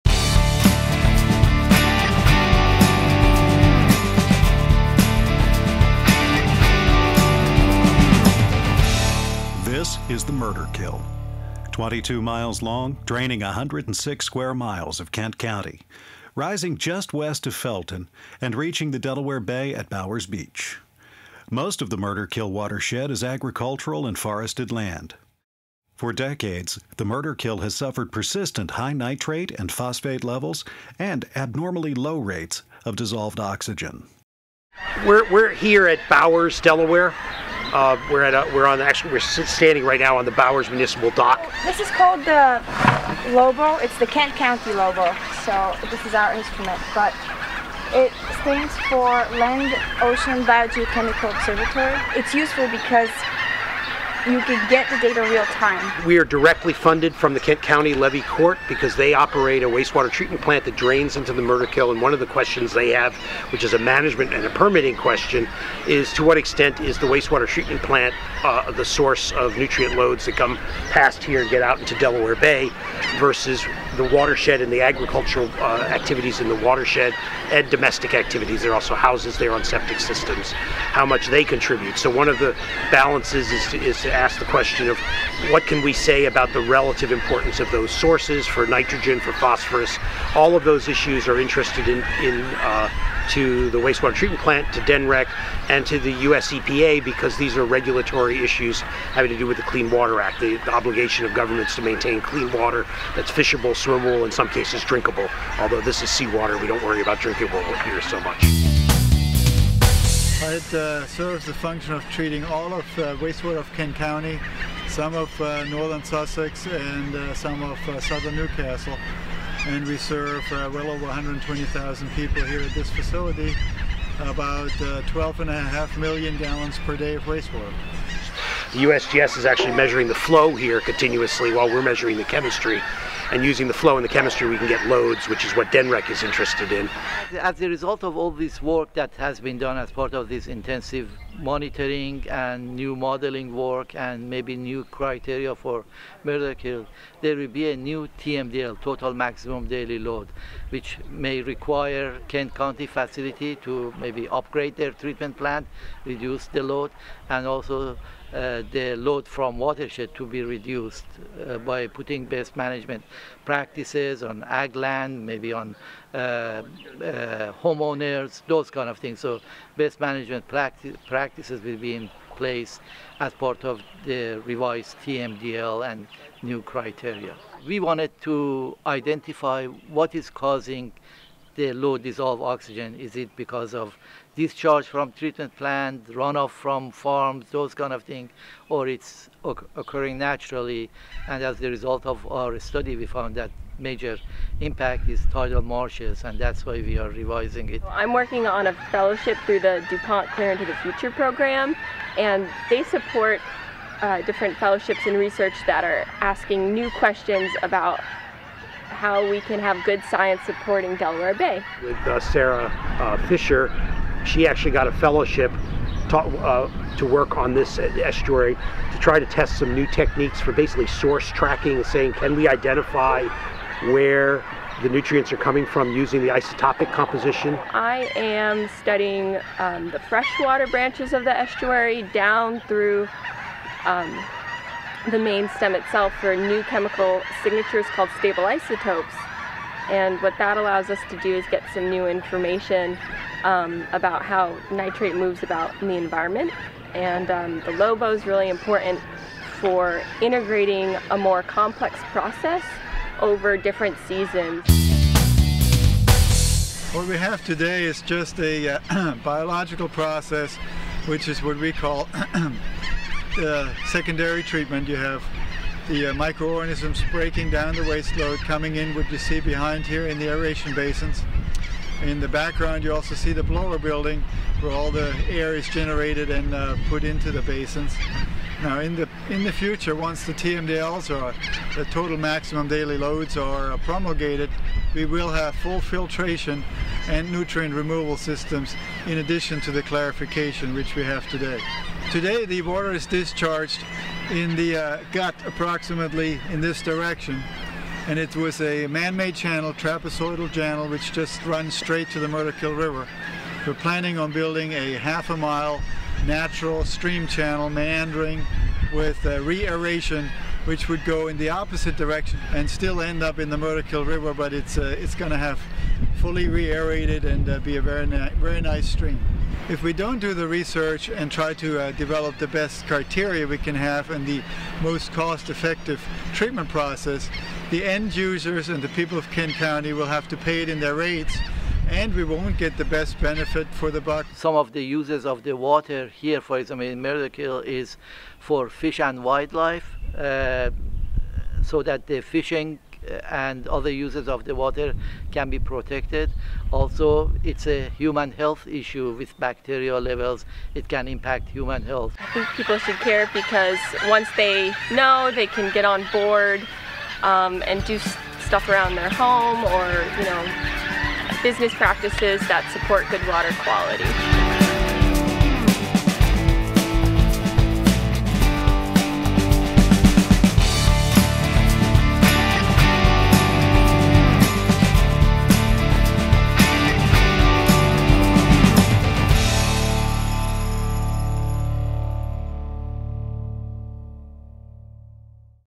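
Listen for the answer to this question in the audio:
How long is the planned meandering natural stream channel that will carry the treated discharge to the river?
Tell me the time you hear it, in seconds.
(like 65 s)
304 s.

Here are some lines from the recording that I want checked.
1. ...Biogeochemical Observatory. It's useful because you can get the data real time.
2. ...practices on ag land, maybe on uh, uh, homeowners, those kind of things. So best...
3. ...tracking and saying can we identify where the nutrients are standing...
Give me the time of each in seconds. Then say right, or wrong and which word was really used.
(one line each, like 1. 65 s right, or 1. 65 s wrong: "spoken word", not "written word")
1. 50 s right
2. 163 s right
3. 221 s wrong: "coming", not "standing".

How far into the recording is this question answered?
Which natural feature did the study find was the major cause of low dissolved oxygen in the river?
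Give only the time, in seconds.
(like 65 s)
195 s.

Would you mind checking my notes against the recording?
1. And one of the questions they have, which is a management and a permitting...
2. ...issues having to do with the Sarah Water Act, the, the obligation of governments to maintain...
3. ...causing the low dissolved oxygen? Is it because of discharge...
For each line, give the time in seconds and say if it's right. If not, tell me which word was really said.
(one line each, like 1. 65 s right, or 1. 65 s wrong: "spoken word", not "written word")
1. 61 s right
2. 98 s wrong: "Clean", not "Sarah"
3. 180 s right.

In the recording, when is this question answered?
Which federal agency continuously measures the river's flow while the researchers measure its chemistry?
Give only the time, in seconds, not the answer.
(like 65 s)
128 s.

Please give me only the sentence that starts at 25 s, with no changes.
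For decades, the Murderkill has suffered persistent high nitrate and phosphate levels and abnormally low rates of dissolved oxygen.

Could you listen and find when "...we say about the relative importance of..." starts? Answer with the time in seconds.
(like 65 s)
85 s.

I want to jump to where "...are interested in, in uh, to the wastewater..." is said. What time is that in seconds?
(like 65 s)
91 s.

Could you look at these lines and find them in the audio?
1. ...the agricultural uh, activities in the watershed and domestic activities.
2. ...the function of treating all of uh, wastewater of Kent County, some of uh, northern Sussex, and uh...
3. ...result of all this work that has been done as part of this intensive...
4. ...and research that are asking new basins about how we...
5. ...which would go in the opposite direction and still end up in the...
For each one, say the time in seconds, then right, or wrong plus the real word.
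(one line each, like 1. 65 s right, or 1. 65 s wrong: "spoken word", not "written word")
1. 74 s right
2. 111 s right
3. 137 s right
4. 205 s wrong: "questions", not "basins"
5. 310 s right.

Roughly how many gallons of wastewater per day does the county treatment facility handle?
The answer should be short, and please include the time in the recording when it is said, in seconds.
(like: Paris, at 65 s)
12.5 million, at 125 s.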